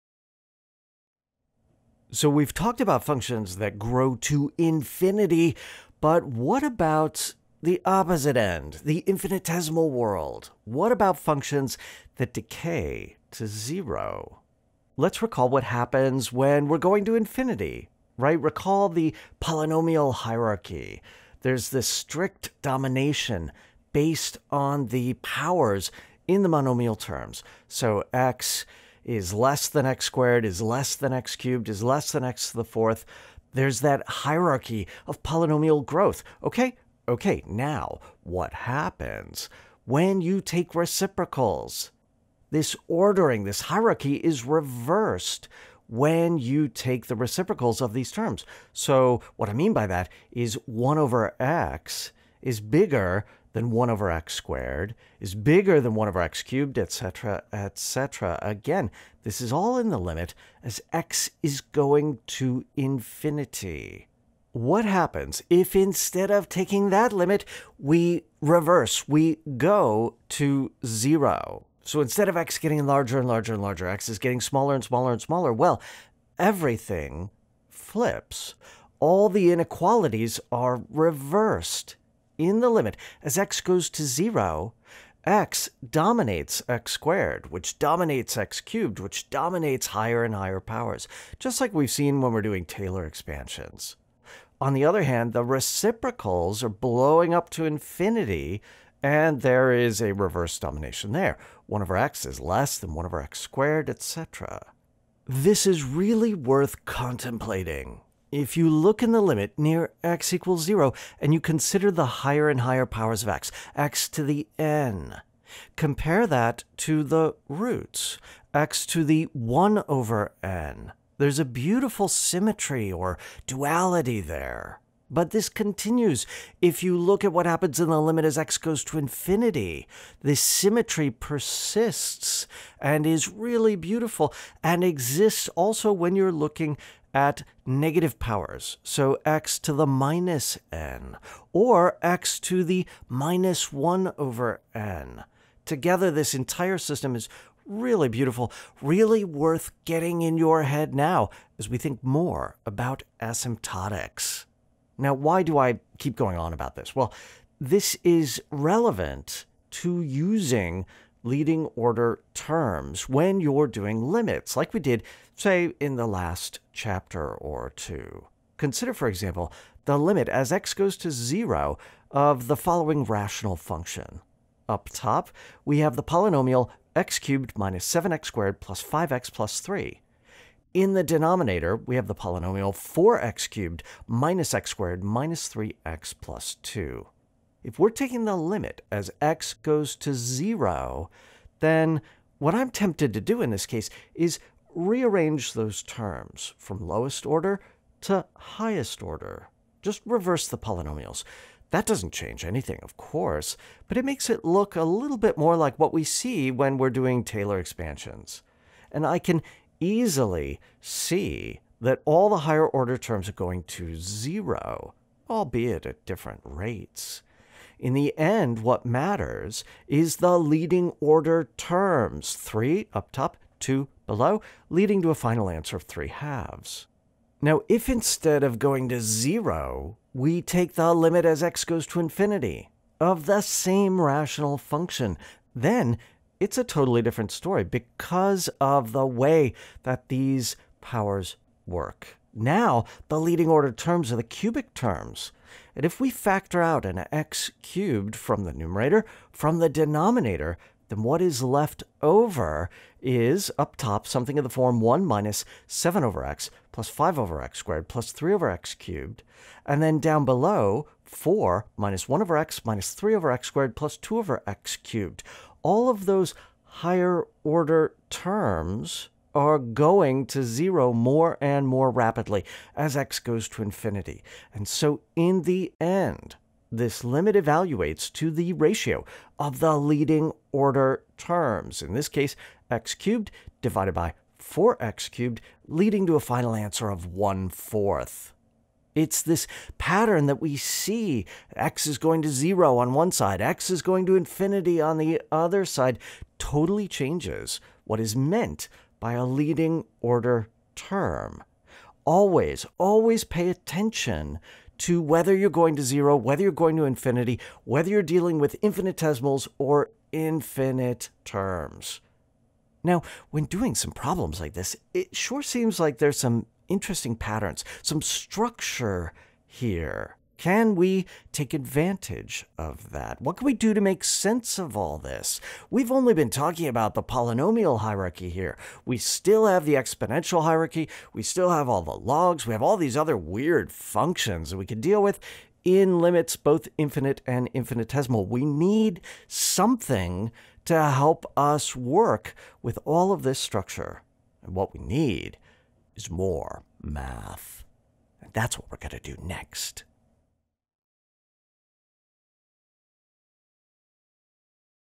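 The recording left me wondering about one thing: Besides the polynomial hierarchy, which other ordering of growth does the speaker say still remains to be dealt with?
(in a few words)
exponential hierarchy.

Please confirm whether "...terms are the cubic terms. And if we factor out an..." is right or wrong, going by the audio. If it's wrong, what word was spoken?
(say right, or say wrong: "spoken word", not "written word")
right.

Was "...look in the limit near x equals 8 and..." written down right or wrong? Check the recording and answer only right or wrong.
wrong.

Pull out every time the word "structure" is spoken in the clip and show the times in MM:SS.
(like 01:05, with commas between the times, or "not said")
05:18, 05:43.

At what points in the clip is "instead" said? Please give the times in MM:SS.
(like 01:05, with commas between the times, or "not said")
01:05, 01:12, 03:47.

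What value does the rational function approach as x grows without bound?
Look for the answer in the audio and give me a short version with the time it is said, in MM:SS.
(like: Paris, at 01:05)
1/4, at 04:47.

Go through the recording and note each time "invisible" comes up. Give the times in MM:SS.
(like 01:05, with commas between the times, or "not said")
not said.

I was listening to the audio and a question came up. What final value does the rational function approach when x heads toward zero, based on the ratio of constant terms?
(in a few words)
3/2.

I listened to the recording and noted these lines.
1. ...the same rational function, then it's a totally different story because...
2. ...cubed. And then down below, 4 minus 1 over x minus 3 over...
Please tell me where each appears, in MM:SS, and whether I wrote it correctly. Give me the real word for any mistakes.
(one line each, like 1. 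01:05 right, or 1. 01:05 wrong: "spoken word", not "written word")
1. 03:53 right
2. 04:18 right.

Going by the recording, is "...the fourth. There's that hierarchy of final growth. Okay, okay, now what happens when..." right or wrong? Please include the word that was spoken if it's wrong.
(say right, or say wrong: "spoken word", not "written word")
wrong: "polynomial", not "final".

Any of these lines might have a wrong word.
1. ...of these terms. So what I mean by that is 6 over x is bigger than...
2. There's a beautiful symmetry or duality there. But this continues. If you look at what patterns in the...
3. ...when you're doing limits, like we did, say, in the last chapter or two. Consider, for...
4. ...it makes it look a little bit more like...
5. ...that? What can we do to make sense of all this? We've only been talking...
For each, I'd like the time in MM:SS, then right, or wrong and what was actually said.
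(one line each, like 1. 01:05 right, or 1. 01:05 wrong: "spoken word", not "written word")
1. 00:47 wrong: "1", not "6"
2. 02:01 wrong: "happens", not "patterns"
3. 02:43 right
4. 03:23 right
5. 05:22 right.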